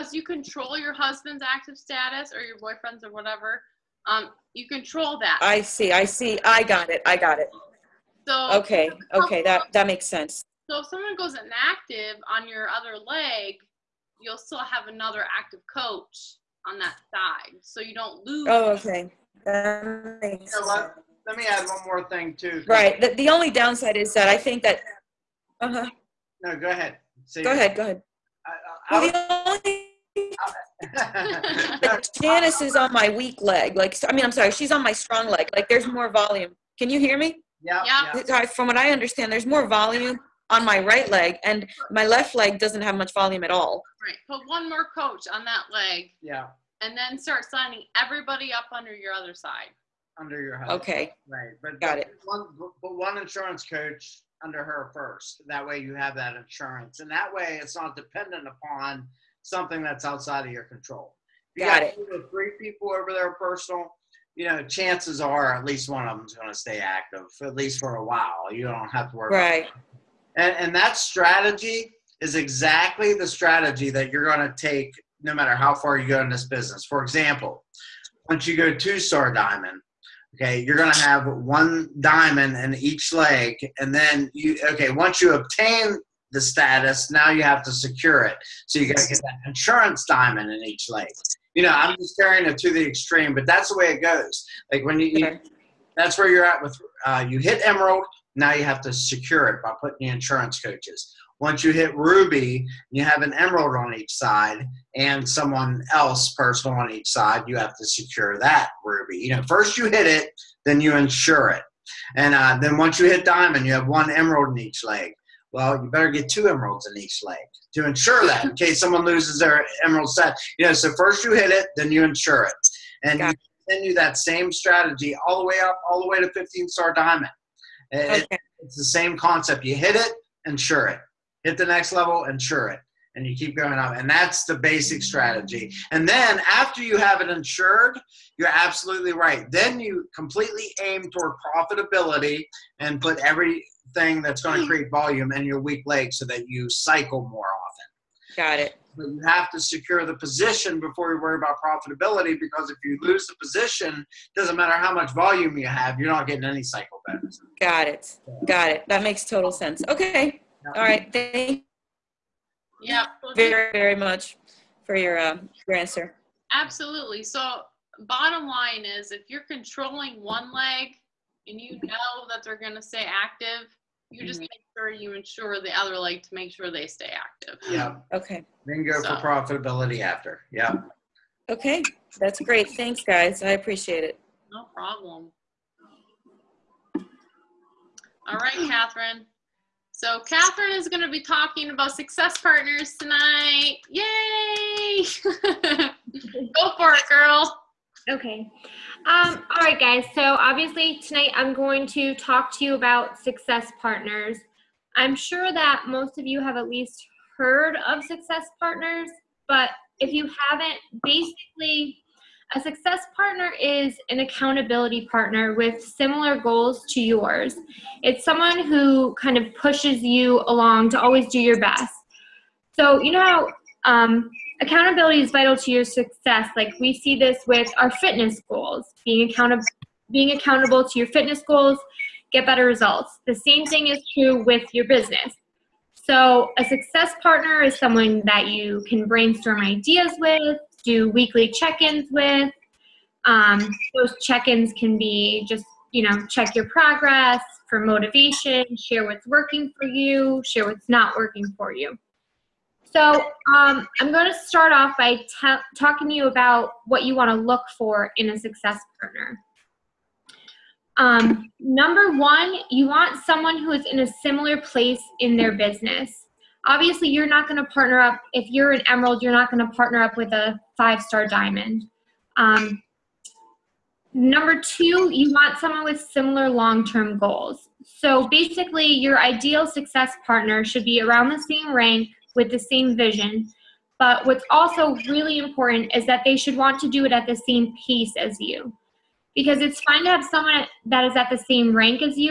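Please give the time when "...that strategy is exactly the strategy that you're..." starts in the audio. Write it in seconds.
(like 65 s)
70 s.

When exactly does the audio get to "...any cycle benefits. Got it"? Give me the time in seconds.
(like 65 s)
156 s.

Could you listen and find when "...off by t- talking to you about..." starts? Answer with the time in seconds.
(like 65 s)
254 s.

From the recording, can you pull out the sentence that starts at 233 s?
The same thing is true with your business.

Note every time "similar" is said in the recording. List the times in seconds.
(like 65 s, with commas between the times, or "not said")
215 s, 264 s, 276 s.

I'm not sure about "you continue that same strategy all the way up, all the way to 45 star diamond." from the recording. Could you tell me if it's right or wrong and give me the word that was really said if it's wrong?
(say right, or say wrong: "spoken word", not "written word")
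wrong: "15", not "45".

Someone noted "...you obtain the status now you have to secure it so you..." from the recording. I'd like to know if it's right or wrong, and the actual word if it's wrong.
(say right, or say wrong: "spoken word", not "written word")
right.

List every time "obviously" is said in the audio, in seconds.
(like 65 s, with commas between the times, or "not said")
200 s, 266 s.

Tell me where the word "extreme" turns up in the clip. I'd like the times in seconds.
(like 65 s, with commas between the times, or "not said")
92 s.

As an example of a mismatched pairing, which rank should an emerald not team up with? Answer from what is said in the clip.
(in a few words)
Five star diamond.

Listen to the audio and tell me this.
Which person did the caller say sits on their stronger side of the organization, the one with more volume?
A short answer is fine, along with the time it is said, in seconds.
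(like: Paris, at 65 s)
Janice, at 32 s.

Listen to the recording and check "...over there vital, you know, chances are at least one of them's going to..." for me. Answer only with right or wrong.
wrong.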